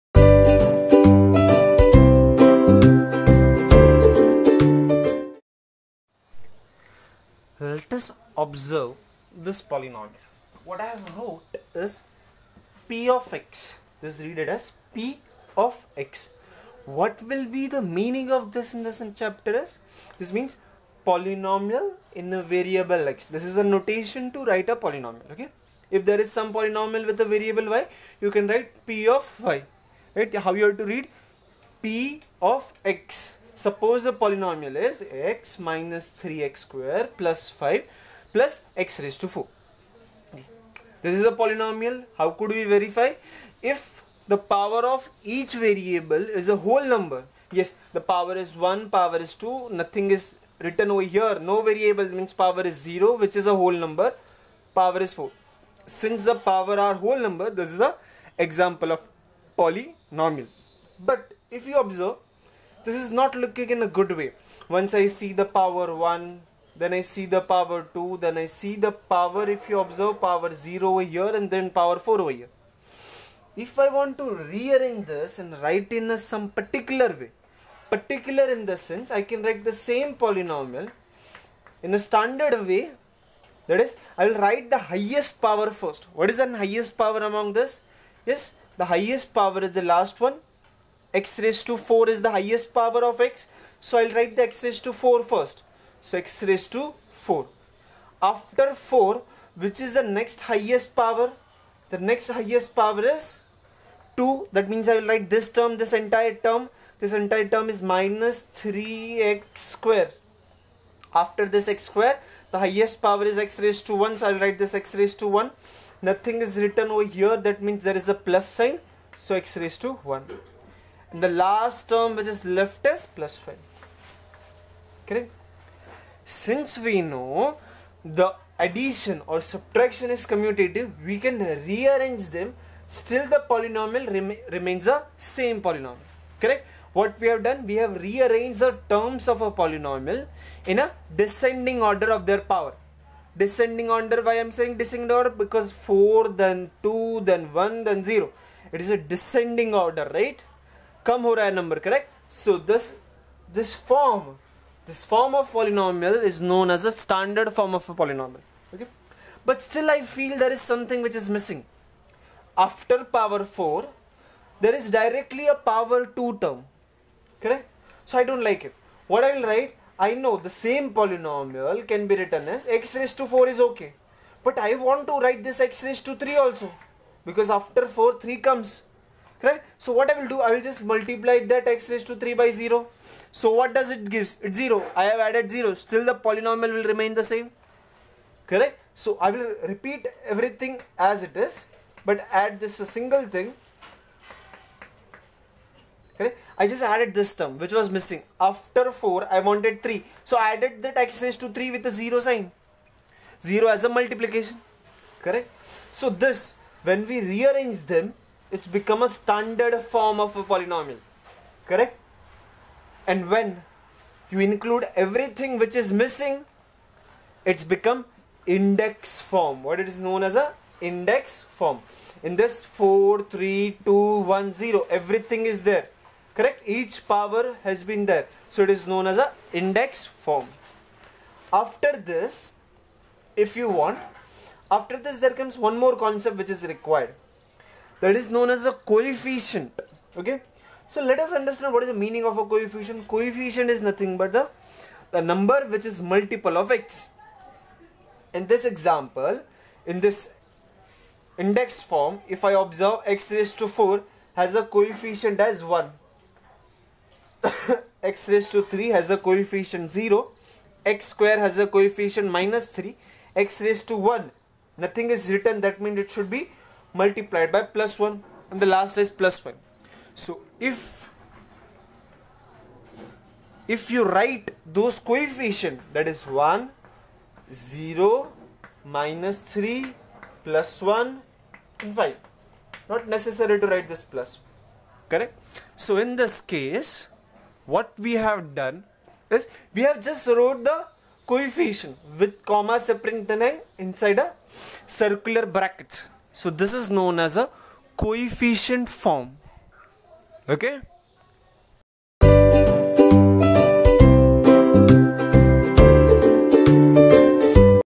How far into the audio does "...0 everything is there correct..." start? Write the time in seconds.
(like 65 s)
224 s.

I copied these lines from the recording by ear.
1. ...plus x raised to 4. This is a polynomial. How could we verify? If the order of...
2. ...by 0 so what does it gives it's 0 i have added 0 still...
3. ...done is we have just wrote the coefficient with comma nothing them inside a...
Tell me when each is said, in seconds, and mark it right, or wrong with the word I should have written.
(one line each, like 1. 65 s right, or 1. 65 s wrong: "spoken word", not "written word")
1. 38 s wrong: "power", not "order"
2. 182 s right
3. 288 s wrong: "separating", not "nothing".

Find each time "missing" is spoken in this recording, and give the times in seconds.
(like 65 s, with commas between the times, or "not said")
161 s, 197 s, 216 s.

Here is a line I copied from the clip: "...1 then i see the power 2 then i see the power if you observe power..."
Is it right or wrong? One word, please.
right.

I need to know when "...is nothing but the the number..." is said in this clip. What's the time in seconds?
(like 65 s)
243 s.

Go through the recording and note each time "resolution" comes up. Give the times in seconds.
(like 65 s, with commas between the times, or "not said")
not said.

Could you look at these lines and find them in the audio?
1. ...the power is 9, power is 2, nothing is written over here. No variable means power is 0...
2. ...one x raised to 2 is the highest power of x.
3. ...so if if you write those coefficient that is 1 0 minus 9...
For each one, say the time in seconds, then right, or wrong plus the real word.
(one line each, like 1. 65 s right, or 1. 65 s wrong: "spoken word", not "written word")
1. 47 s wrong: "1", not "9"
2. 90 s wrong: "4", not "2"
3. 270 s wrong: "3", not "9".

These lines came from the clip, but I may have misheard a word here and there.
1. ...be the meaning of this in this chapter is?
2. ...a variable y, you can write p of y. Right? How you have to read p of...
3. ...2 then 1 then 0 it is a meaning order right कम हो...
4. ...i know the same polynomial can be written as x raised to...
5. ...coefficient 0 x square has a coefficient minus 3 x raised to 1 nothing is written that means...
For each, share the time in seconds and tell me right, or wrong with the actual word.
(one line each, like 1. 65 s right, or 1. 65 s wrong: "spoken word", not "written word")
1. 17 s right
2. 27 s right
3. 146 s wrong: "descending", not "meaning"
4. 170 s right
5. 259 s right.